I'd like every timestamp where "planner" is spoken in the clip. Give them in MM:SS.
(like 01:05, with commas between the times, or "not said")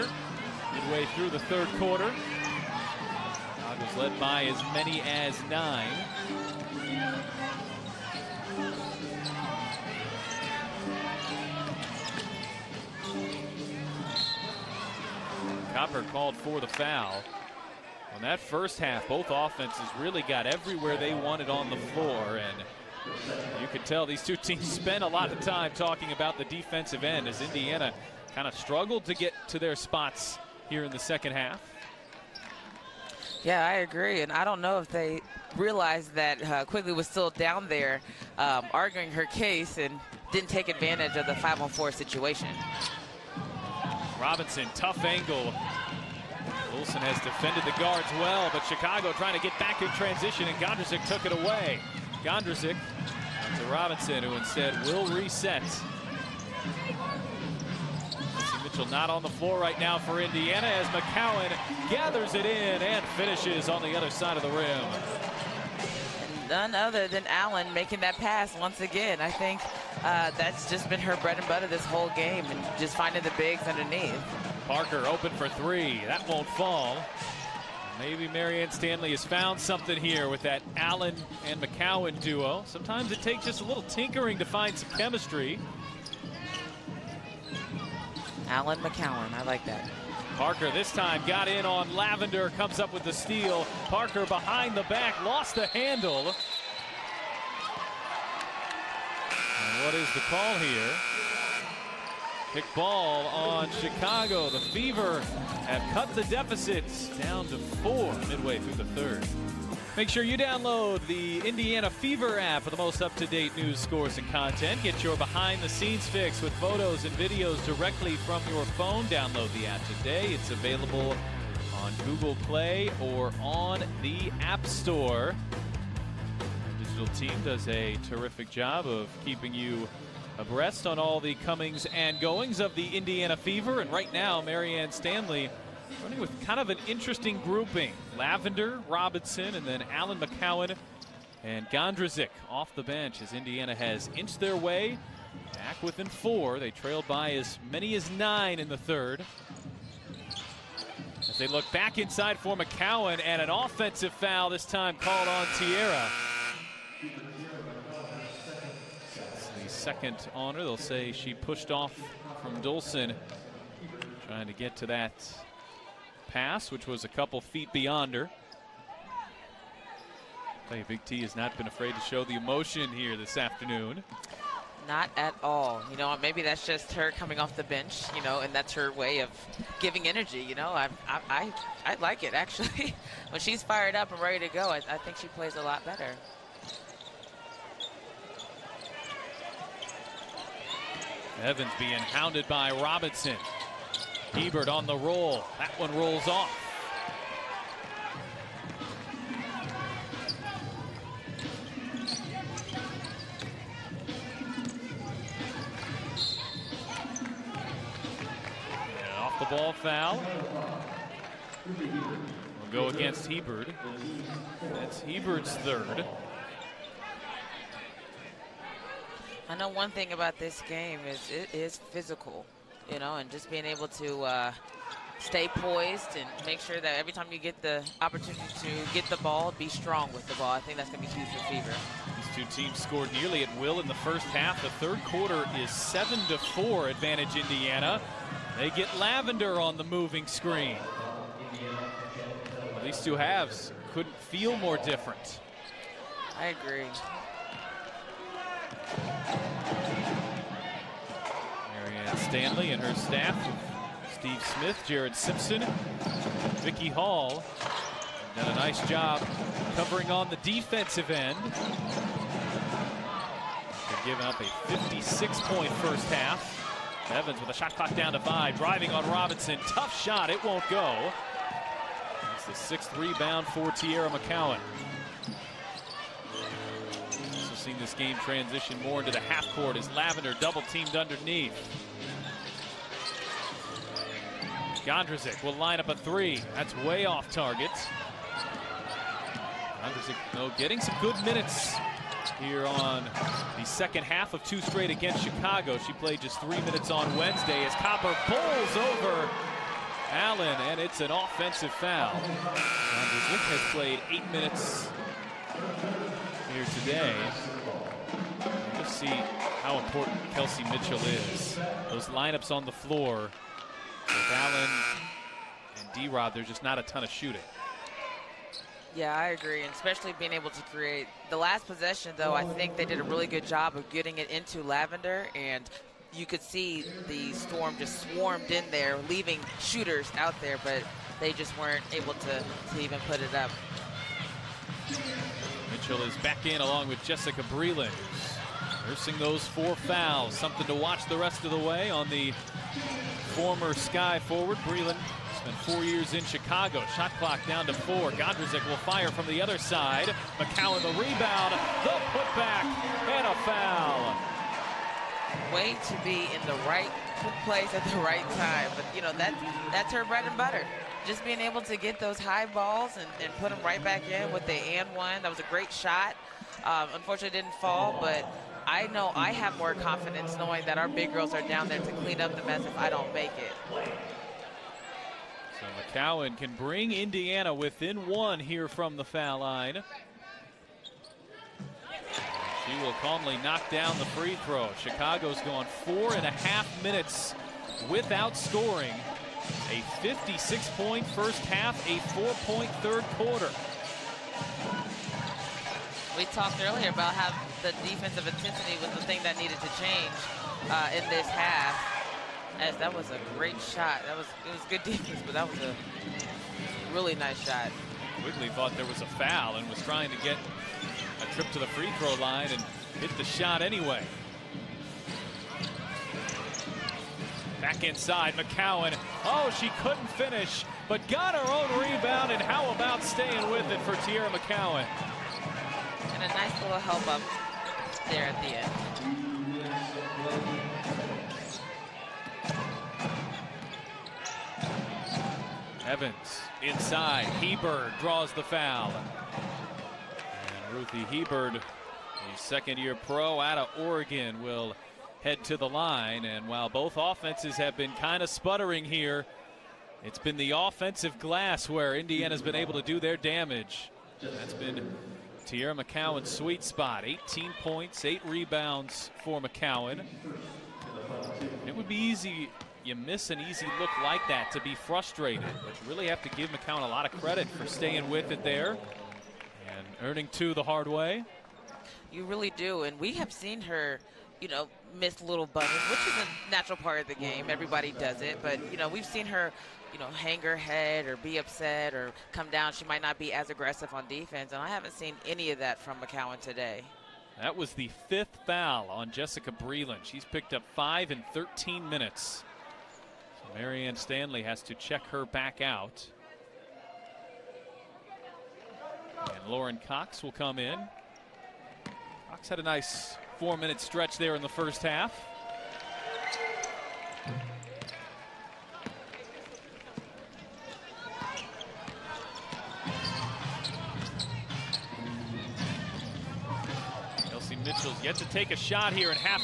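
not said.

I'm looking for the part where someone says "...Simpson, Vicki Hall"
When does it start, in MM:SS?
04:15.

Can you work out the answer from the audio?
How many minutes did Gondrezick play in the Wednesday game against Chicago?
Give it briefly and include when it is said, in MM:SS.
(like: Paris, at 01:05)
3, at 04:56.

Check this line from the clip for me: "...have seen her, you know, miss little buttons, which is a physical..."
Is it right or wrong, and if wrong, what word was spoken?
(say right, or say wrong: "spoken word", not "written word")
wrong: "natural", not "physical".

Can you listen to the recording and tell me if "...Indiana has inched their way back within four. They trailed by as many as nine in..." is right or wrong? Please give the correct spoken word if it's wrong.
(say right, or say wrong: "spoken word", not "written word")
right.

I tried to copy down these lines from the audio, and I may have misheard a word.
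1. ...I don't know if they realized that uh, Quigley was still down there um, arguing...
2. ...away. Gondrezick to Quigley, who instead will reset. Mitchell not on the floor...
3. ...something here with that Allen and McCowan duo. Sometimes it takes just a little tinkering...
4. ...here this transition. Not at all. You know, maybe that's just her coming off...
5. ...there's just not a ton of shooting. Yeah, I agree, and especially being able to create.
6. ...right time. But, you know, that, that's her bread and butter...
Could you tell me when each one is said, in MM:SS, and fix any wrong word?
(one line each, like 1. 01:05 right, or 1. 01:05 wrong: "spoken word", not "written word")
1. 00:34 right
2. 00:51 wrong: "Robinson", not "Quigley"
3. 01:19 right
4. 02:52 wrong: "afternoon", not "transition"
5. 05:16 right
6. 05:57 right.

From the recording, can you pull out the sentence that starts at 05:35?
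Mitchell is back in along with Jessica Breland.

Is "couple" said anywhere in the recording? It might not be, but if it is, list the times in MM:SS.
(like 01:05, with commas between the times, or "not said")
02:47.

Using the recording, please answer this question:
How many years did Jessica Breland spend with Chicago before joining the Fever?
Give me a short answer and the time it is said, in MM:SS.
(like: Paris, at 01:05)
4, at 05:45.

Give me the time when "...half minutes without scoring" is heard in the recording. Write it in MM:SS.
06:26.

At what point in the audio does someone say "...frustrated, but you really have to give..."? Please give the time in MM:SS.
07:44.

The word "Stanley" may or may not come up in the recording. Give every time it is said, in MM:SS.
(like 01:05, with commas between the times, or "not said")
01:18, 02:14, 04:12, 08:13.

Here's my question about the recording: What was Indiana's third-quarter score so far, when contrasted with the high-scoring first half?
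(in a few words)
7 to 4.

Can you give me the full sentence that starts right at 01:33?
Parker behind the back, lost the handle.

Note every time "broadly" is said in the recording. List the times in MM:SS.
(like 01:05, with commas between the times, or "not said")
not said.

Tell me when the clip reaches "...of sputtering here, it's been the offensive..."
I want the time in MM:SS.
07:28.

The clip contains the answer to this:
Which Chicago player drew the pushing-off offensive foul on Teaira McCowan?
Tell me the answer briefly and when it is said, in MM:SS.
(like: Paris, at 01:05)
Dolson, at 02:42.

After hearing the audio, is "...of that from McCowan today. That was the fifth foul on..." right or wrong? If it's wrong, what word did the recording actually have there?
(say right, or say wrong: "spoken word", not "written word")
right.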